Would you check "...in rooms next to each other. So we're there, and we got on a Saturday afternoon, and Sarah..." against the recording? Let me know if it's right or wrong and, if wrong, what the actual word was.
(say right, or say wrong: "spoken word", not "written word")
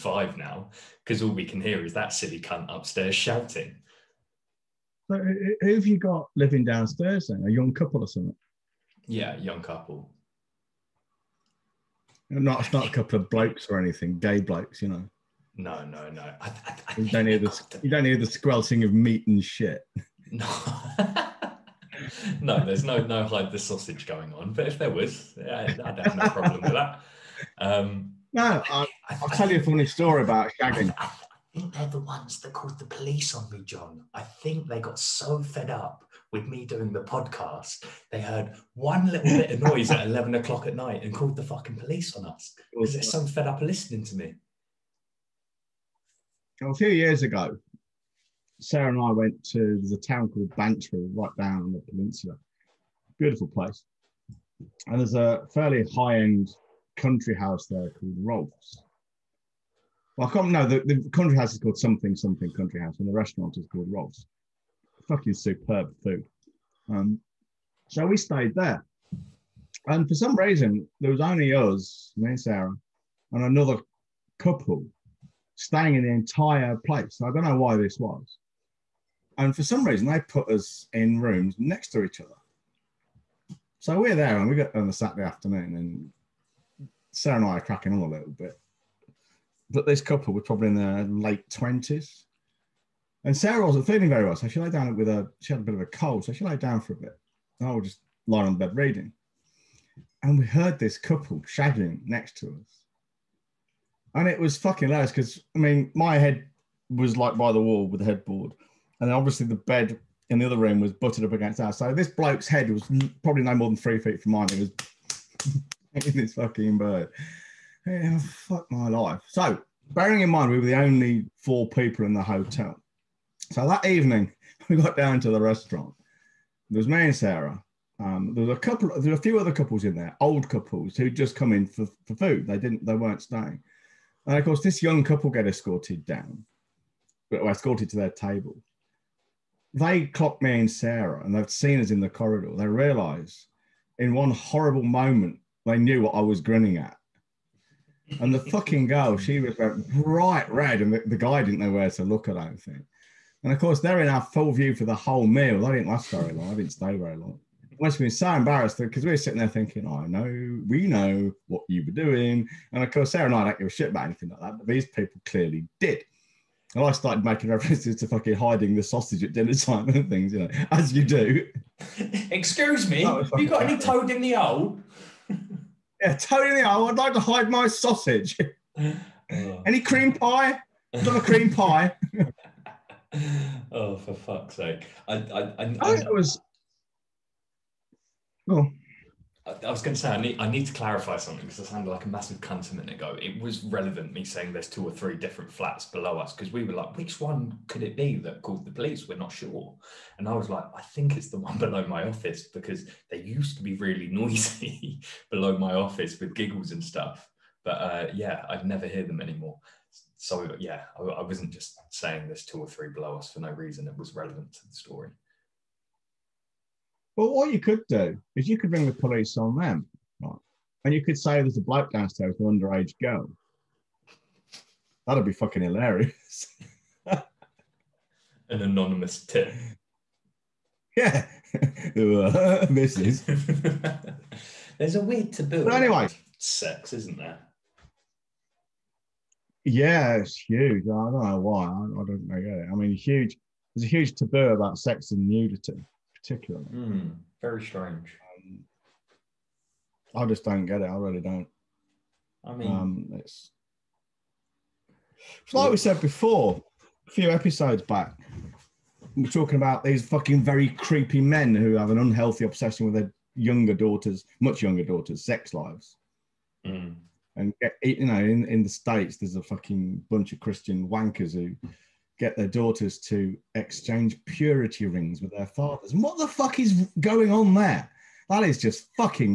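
right.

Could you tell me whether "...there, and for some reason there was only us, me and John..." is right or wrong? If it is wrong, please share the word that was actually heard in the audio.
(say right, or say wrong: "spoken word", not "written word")
wrong: "Sarah", not "John".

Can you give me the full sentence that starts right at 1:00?
No, the, the country house is called something something country house, and the restaurant is called Rolf's.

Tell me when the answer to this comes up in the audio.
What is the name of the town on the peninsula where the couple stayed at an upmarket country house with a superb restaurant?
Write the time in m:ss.
0:50.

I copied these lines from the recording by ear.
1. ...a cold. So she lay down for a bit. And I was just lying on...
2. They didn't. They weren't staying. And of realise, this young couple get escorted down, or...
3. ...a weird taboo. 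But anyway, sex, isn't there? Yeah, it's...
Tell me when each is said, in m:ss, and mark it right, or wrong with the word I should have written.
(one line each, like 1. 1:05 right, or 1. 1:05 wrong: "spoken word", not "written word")
1. 1:35 right
2. 2:12 wrong: "course", not "realise"
3. 3:54 right.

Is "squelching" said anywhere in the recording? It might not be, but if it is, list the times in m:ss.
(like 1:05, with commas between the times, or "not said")
0:18.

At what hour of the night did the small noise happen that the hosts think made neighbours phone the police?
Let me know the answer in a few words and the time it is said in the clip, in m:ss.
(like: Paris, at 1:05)
11 o'clock, at 0:40.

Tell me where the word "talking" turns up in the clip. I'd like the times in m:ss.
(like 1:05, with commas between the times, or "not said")
4:19.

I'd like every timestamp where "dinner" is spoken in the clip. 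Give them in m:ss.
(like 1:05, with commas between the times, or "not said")
2:49.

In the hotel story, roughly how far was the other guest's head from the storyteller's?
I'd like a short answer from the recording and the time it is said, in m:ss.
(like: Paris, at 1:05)
3 feet, at 1:53.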